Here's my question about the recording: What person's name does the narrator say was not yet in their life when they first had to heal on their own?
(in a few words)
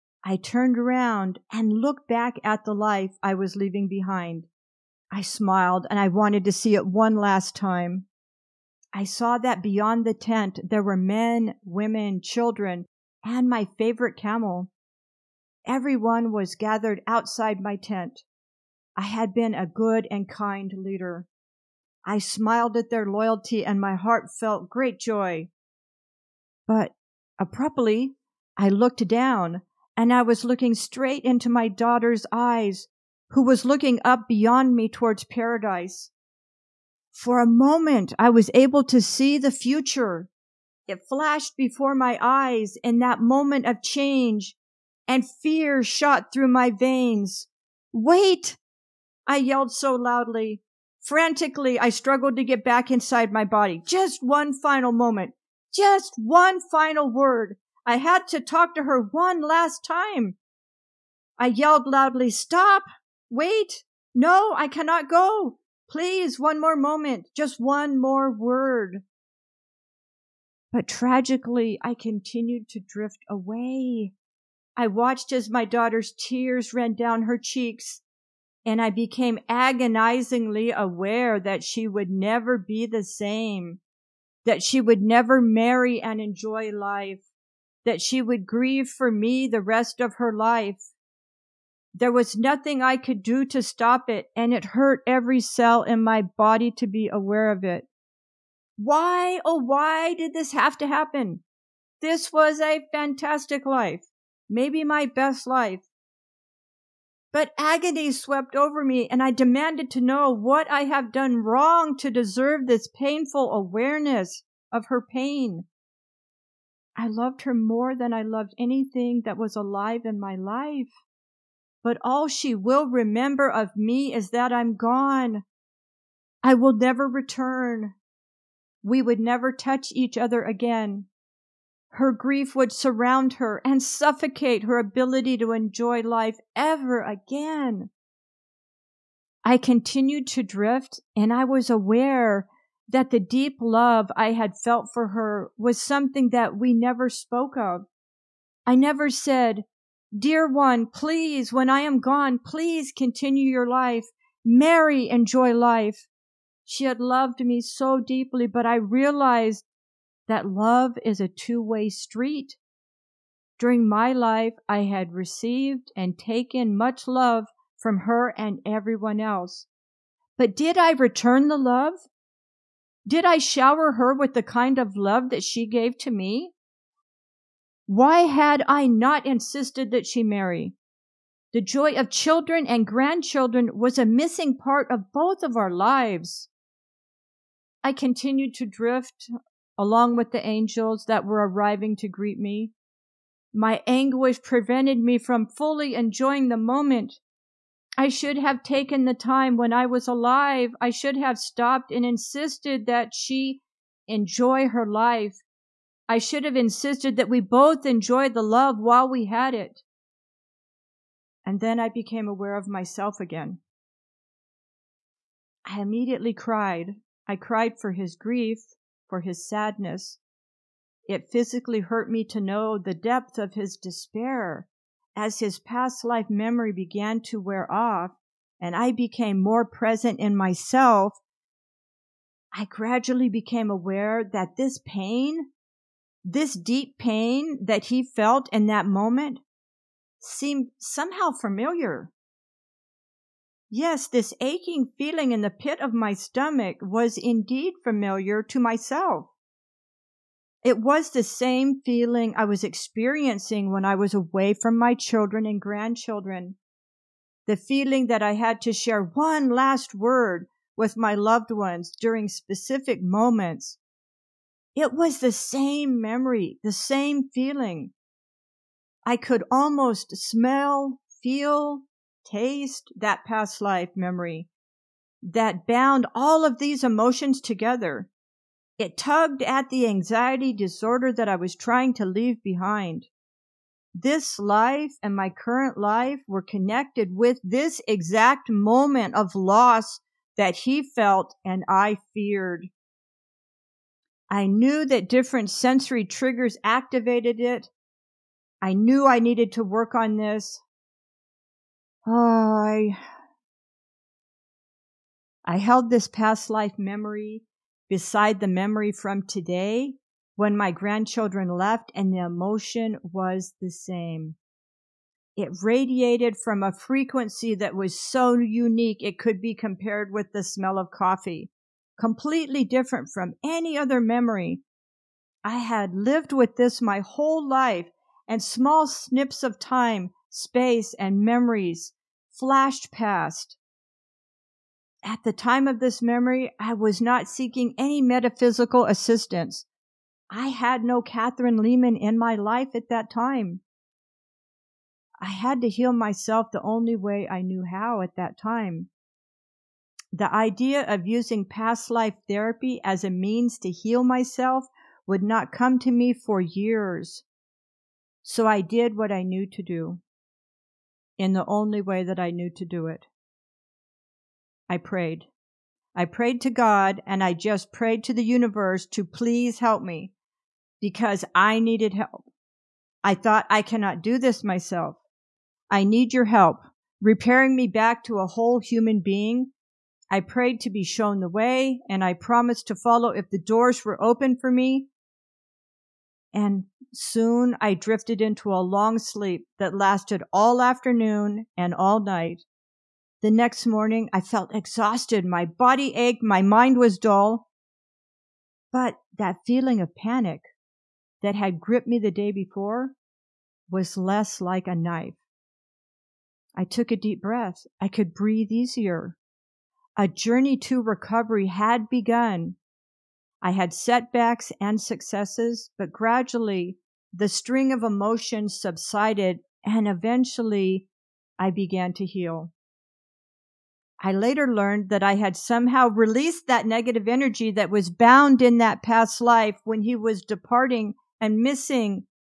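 Kathryn Leeman.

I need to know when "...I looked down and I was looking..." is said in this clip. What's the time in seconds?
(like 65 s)
28 s.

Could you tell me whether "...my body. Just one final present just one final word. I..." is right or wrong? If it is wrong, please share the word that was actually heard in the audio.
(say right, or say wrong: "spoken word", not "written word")
wrong: "moment", not "present".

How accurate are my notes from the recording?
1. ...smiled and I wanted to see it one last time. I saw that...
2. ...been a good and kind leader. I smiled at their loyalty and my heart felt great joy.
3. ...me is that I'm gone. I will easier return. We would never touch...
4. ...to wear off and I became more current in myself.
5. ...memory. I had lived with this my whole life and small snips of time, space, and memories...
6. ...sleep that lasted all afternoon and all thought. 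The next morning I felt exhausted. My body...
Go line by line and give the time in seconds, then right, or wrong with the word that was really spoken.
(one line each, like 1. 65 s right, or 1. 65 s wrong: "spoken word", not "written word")
1. 5 s right
2. 19 s right
3. 123 s wrong: "never", not "easier"
4. 227 s wrong: "present", not "current"
5. 323 s right
6. 388 s wrong: "night", not "thought".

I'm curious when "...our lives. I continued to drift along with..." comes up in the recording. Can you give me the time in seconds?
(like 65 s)
185 s.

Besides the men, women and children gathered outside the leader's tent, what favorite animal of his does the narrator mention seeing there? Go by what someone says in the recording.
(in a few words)
camel.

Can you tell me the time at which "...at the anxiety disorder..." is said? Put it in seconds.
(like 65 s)
279 s.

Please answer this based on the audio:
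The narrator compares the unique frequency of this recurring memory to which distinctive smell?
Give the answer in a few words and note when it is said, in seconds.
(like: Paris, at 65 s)
coffee, at 320 s.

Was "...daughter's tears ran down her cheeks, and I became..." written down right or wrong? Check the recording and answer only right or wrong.
right.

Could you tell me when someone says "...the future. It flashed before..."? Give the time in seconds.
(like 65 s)
39 s.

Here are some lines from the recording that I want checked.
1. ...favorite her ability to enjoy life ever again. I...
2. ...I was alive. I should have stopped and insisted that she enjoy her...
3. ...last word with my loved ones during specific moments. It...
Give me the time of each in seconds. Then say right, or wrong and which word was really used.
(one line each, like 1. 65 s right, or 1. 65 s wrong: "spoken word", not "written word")
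1. 133 s wrong: "suffocate", not "favorite"
2. 199 s right
3. 259 s right.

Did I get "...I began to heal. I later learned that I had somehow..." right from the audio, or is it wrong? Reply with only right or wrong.
right.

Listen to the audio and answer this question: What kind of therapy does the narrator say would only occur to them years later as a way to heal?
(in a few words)
past life therapy.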